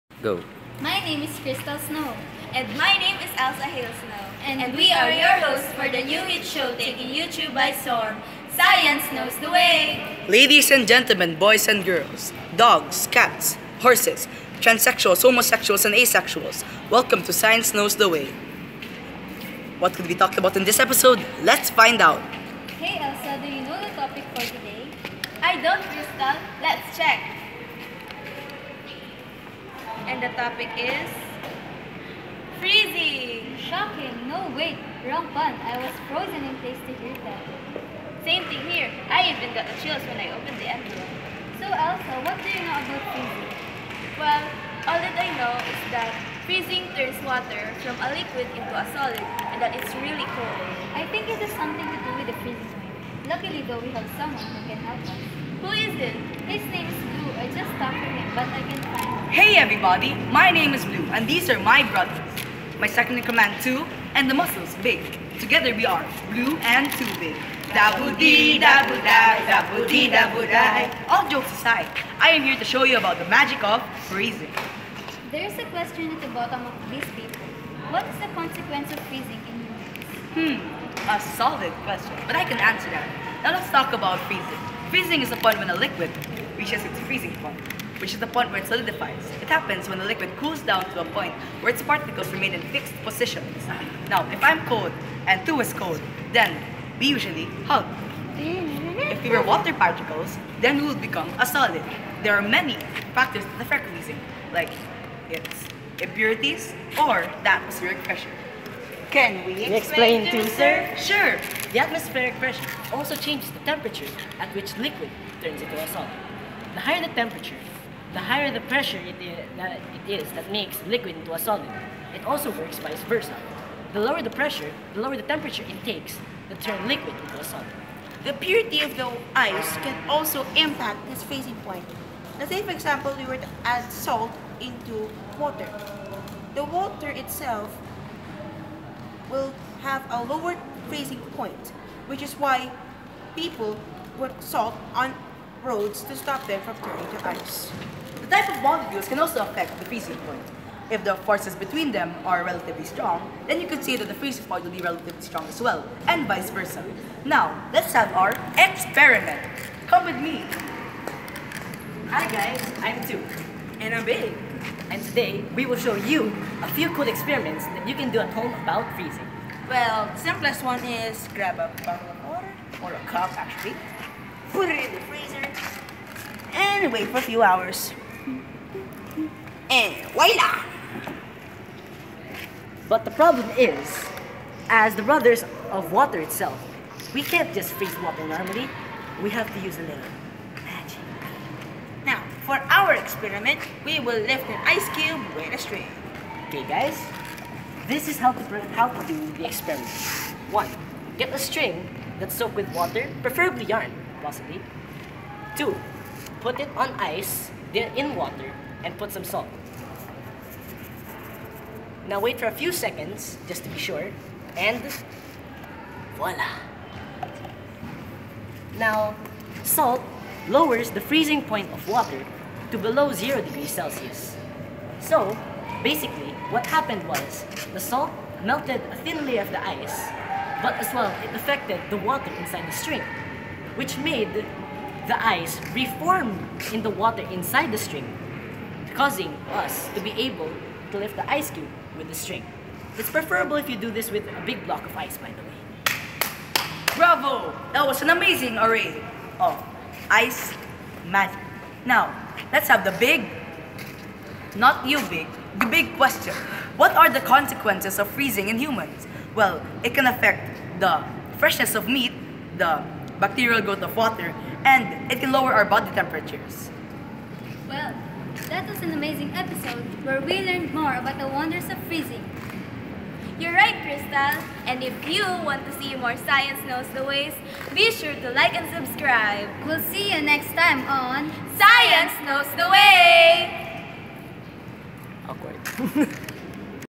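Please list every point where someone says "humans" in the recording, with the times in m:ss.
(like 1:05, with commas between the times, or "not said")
1:20, 4:18.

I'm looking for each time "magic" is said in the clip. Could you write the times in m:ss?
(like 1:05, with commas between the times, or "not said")
1:13, 4:11.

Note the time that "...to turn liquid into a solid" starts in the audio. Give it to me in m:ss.
2:06.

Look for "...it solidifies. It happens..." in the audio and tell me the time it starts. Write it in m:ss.
1:28.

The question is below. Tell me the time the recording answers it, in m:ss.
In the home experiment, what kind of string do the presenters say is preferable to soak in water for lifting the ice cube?
3:23.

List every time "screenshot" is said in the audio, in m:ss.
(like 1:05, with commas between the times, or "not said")
not said.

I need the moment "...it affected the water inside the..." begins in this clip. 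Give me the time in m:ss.
3:51.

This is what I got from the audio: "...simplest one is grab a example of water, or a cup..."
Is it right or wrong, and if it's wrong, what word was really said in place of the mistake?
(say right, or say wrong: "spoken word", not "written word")
wrong: "bottle", not "example".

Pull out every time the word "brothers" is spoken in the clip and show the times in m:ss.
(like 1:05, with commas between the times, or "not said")
1:01, 3:05.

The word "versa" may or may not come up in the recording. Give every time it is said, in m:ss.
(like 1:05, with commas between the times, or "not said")
2:03, 2:36.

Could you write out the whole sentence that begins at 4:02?
It's preferable if you do this with a big block of ice, by the way.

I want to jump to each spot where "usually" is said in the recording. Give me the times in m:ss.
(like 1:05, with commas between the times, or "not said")
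1:37.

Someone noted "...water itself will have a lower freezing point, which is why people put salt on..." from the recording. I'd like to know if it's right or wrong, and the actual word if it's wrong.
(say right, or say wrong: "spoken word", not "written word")
right.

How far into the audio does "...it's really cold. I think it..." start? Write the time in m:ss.
0:49.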